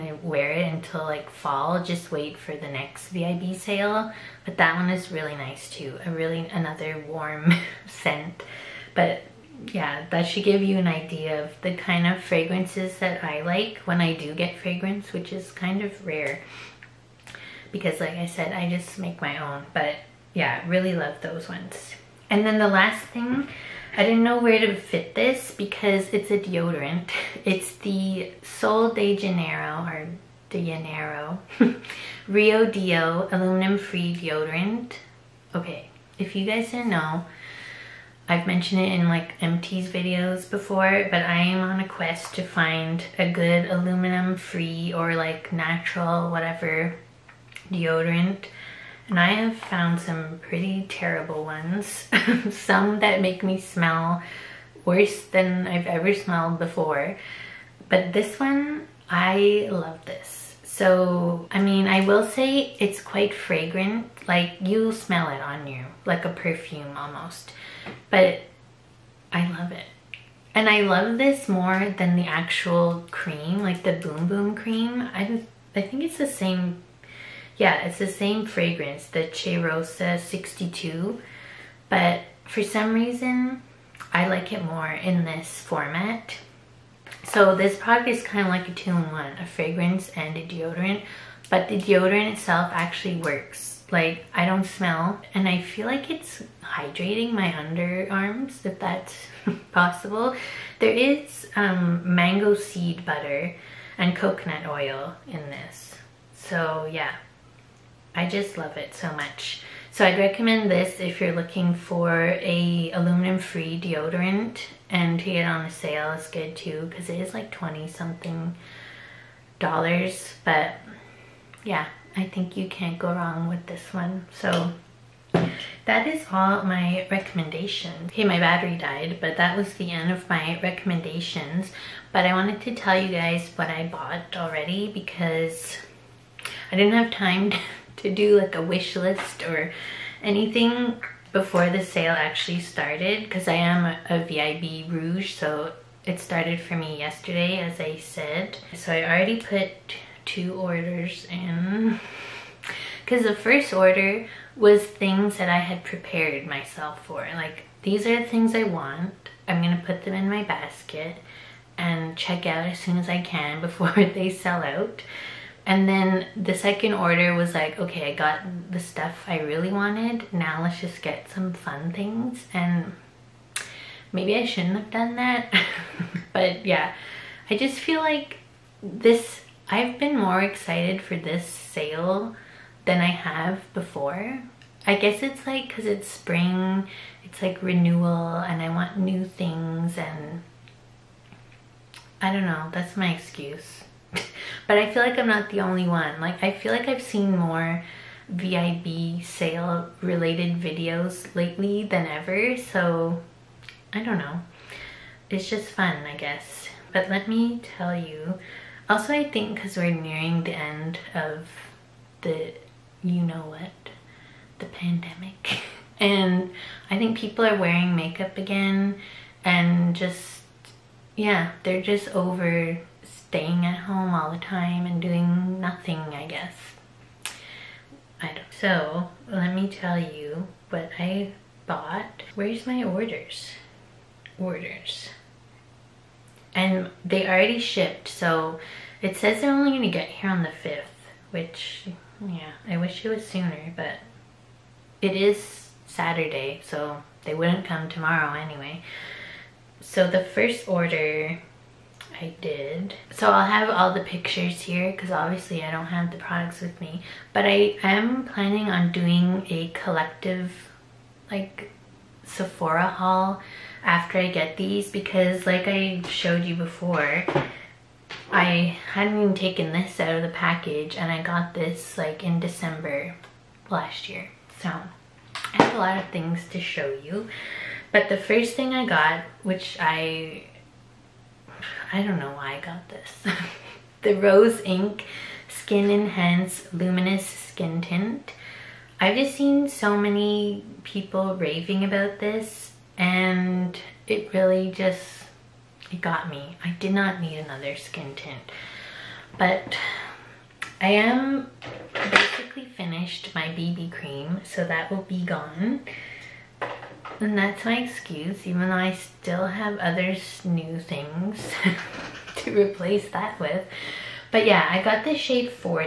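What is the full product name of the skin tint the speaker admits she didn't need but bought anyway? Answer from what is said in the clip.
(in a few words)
Rose Inc Skin Enhance Luminous Skin Tint.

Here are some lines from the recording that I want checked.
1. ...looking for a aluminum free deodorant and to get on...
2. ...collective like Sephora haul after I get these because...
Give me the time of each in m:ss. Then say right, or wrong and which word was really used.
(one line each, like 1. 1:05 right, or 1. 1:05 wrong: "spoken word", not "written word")
1. 1:51 right
2. 4:19 right.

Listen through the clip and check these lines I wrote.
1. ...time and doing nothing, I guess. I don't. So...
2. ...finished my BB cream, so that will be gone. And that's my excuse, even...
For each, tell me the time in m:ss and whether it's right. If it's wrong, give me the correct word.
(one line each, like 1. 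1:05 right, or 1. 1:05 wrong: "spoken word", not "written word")
1. 3:44 right
2. 5:02 right.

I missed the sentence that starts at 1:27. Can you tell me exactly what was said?
So this product is kind of like a two-in-one, a fragrance and a deodorant, but the deodorant itself actually works.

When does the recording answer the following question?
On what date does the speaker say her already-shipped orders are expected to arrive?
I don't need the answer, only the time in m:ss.
4:00.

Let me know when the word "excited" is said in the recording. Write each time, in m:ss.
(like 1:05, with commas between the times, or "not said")
3:00.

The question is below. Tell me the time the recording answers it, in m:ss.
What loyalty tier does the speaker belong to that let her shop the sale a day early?
2:24.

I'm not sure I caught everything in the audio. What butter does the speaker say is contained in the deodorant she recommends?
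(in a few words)
mango seed butter.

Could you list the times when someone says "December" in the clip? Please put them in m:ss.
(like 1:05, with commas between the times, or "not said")
4:32.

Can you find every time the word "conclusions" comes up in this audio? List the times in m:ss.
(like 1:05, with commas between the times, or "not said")
not said.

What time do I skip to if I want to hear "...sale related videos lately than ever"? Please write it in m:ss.
3:19.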